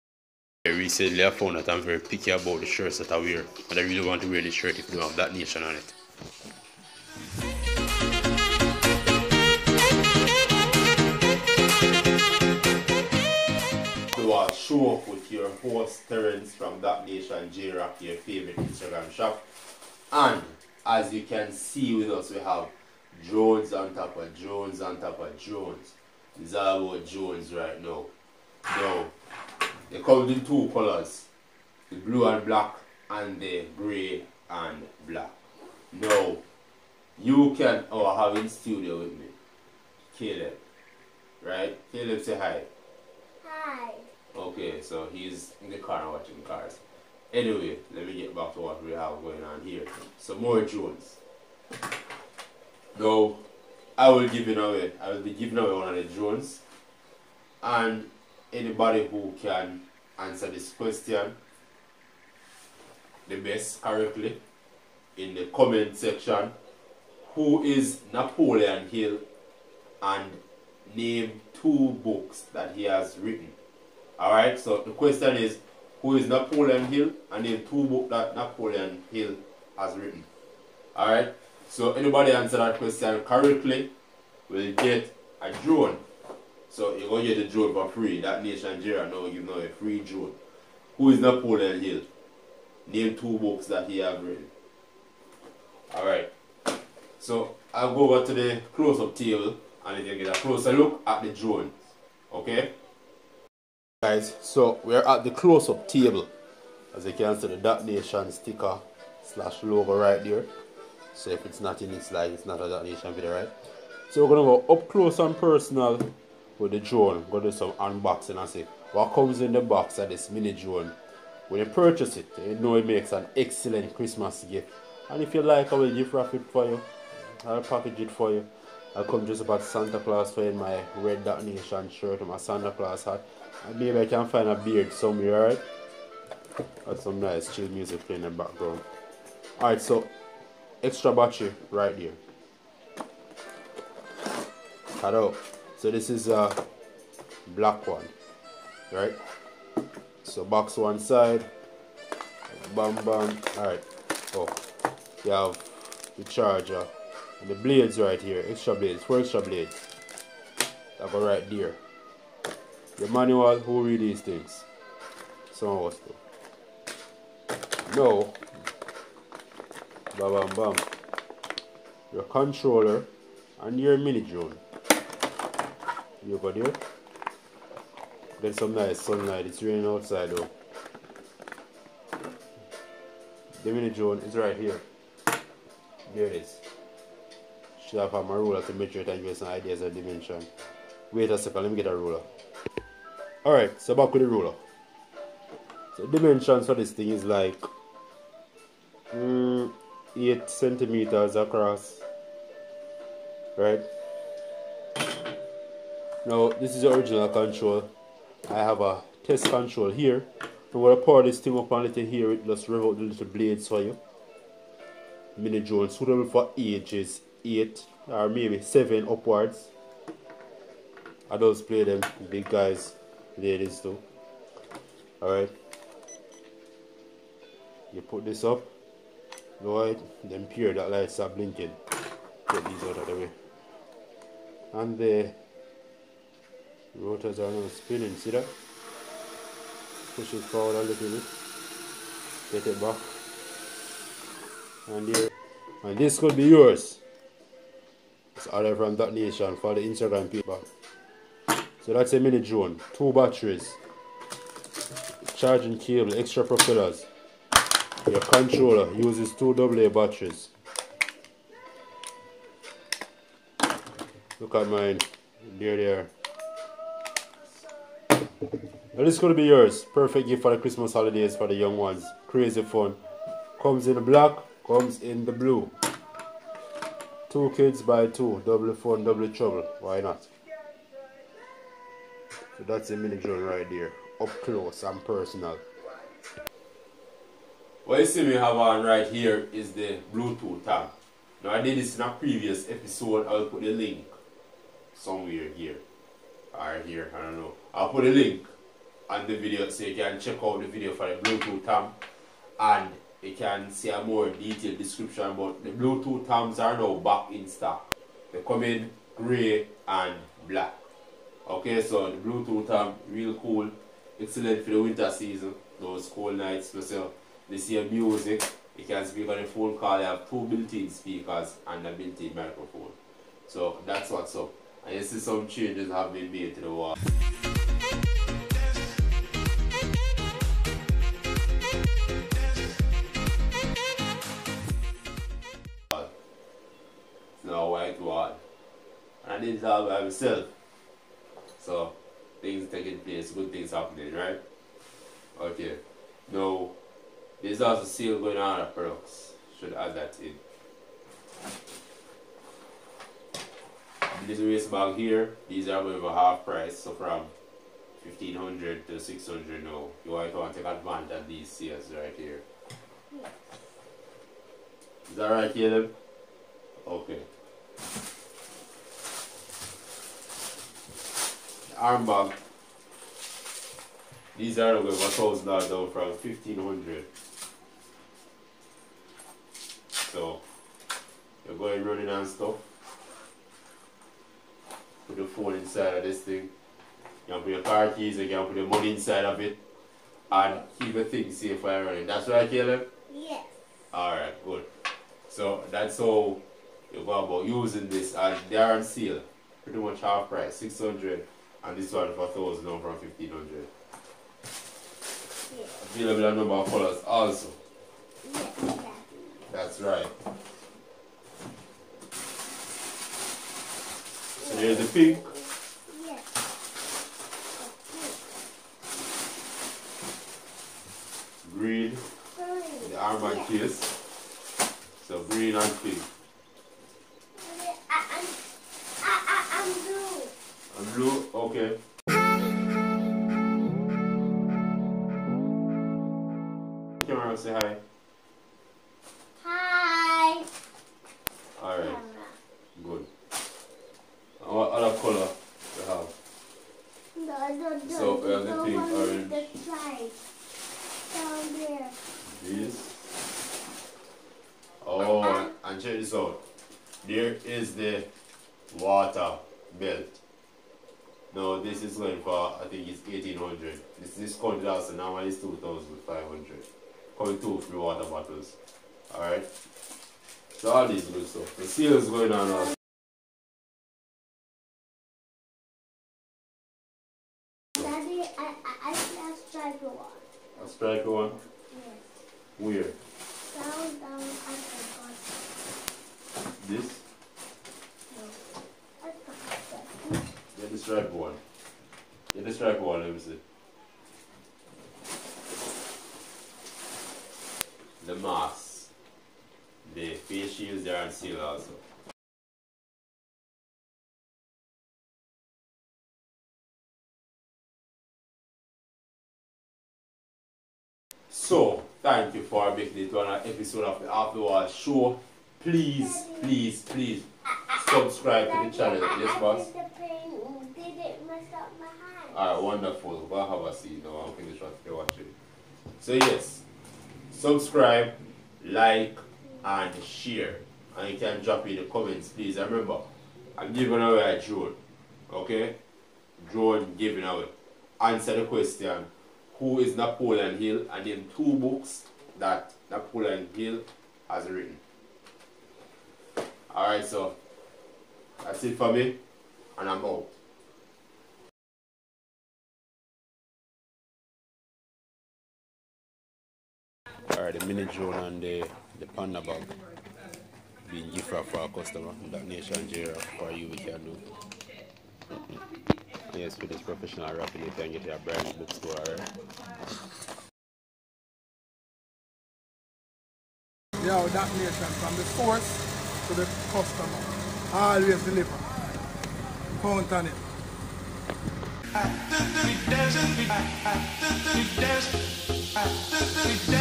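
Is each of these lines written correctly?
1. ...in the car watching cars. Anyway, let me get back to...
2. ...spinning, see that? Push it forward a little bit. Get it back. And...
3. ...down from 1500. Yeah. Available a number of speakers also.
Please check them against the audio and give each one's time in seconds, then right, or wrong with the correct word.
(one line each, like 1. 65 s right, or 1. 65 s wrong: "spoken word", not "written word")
1. 45 s right
2. 237 s right
3. 402 s wrong: "colors", not "speakers".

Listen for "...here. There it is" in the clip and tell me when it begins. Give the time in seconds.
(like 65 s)
184 s.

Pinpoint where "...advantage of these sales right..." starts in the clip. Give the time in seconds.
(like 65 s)
360 s.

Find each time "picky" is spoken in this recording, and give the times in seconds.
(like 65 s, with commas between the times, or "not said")
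1 s.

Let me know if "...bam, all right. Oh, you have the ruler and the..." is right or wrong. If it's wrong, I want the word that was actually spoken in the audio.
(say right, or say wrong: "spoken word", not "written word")
wrong: "charger", not "ruler".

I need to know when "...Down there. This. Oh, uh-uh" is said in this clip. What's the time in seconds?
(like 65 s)
451 s.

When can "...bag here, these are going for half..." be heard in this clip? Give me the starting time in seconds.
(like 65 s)
354 s.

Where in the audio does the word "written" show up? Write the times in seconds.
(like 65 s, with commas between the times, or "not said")
73 s, 79 s, 94 s, 544 s.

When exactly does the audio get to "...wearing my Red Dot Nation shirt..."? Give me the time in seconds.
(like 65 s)
130 s.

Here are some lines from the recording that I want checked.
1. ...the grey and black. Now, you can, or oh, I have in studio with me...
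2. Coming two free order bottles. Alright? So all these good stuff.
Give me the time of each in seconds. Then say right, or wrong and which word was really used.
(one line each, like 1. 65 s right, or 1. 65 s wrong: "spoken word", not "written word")
1. 33 s right
2. 467 s wrong: "water", not "order".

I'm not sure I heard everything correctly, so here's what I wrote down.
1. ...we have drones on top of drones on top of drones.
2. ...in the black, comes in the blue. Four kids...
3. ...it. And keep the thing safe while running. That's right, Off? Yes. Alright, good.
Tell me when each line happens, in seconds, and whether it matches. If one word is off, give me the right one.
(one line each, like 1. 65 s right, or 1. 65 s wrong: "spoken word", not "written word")
1. 22 s right
2. 273 s wrong: "Two", not "Four"
3. 389 s wrong: "Caleb", not "Off".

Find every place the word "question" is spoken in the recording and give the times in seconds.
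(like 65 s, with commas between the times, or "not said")
60 s, 74 s, 82 s, 538 s.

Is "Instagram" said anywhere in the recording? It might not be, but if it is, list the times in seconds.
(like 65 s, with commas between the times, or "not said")
18 s, 249 s.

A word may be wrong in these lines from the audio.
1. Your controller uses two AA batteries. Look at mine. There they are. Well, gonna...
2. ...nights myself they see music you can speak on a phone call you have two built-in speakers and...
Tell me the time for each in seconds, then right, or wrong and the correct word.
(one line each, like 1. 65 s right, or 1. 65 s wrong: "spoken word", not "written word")
1. 258 s right
2. 316 s right.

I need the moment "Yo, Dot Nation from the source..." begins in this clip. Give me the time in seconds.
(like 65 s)
574 s.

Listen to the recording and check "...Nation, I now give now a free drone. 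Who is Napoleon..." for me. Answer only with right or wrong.
right.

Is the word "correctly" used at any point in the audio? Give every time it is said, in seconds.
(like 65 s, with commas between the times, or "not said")
63 s, 83 s.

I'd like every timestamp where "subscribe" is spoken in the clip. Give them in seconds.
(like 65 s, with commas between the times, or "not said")
517 s, 527 s.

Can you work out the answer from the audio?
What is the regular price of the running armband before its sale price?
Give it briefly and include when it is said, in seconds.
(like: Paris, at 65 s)
1500, at 376 s.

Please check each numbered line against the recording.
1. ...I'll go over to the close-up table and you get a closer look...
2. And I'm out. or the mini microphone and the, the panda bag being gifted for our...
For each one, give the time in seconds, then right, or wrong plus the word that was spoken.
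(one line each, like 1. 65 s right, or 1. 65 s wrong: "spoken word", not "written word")
1. 97 s right
2. 549 s wrong: "drone", not "microphone".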